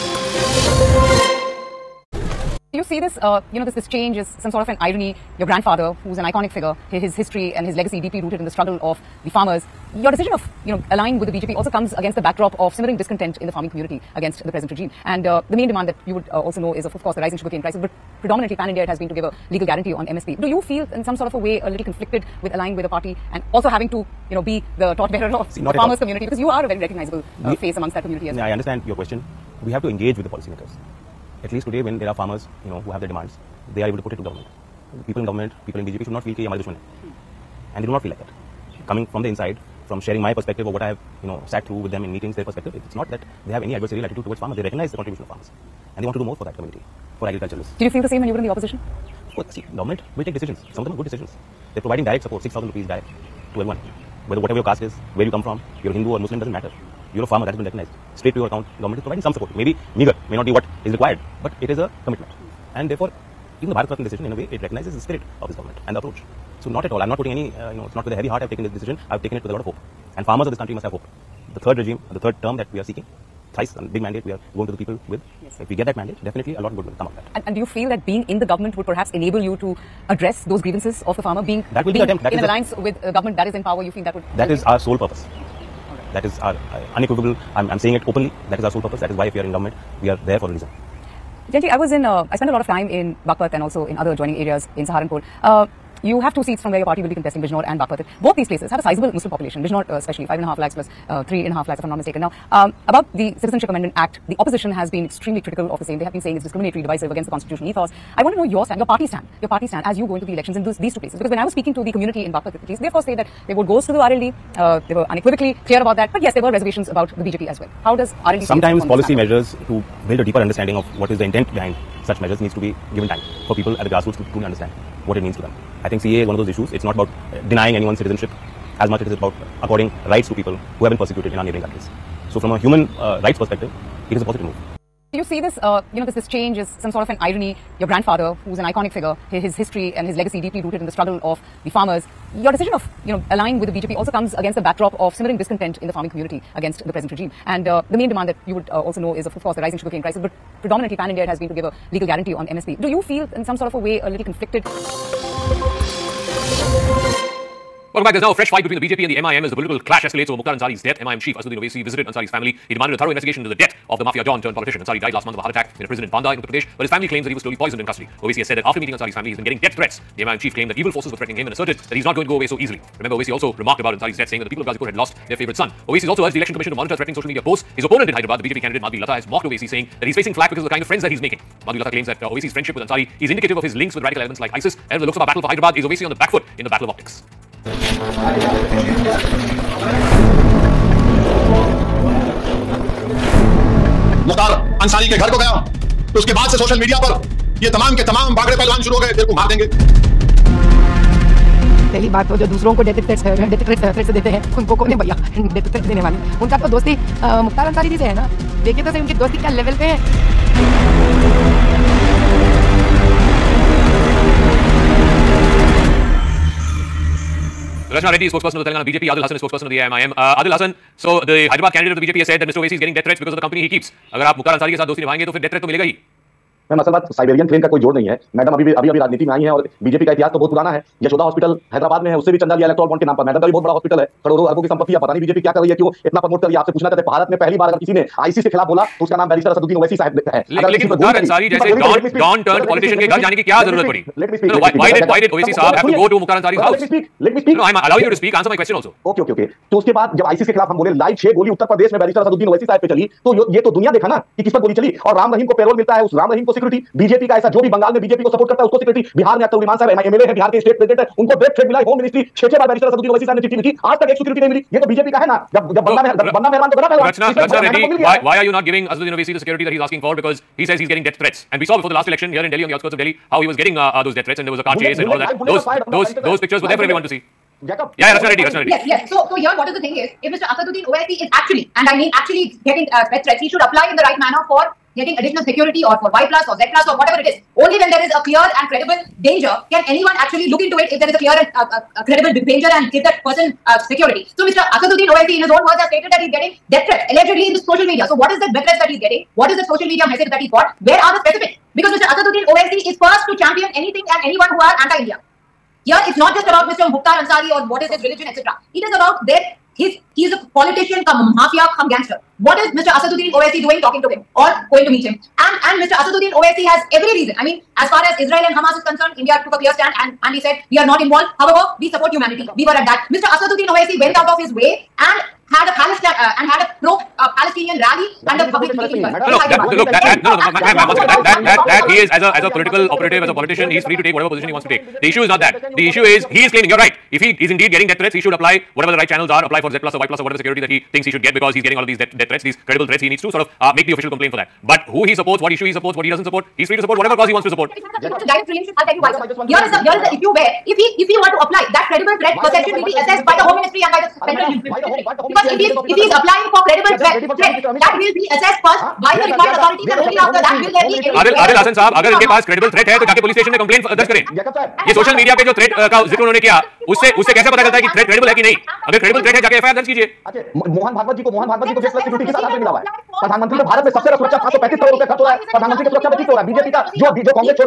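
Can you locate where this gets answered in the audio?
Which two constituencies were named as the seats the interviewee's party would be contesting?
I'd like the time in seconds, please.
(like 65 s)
97 s.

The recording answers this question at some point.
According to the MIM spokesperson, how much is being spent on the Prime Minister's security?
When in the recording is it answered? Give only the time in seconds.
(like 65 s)
374 s.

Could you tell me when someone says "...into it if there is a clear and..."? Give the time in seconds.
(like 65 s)
290 s.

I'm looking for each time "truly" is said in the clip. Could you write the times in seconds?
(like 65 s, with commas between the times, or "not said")
124 s.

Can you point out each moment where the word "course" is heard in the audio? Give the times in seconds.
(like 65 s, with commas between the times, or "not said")
17 s, 49 s, 112 s, 149 s.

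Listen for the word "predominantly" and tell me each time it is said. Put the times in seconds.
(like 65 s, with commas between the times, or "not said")
18 s, 150 s.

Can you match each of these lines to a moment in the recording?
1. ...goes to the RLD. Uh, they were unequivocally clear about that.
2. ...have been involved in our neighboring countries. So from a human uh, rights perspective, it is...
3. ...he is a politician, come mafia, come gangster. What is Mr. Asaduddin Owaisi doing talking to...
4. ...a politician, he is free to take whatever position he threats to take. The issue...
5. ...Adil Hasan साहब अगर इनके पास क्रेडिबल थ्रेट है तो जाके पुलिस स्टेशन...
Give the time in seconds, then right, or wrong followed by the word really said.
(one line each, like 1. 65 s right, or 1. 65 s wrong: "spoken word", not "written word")
1. 113 s right
2. 130 s wrong: "persecuted", not "involved"
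3. 310 s right
4. 333 s wrong: "wants", not "threats"
5. 361 s right.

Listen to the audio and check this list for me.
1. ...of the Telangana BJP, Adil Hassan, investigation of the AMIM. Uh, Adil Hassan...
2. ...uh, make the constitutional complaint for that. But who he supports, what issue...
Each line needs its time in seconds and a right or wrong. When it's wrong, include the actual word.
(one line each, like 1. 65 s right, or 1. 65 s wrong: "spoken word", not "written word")
1. 218 s wrong: "spokesperson", not "investigation"
2. 343 s wrong: "official", not "constitutional".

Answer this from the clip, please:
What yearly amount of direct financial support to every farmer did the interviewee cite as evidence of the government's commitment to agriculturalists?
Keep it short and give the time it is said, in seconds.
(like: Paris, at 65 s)
6,000 rupees, at 52 s.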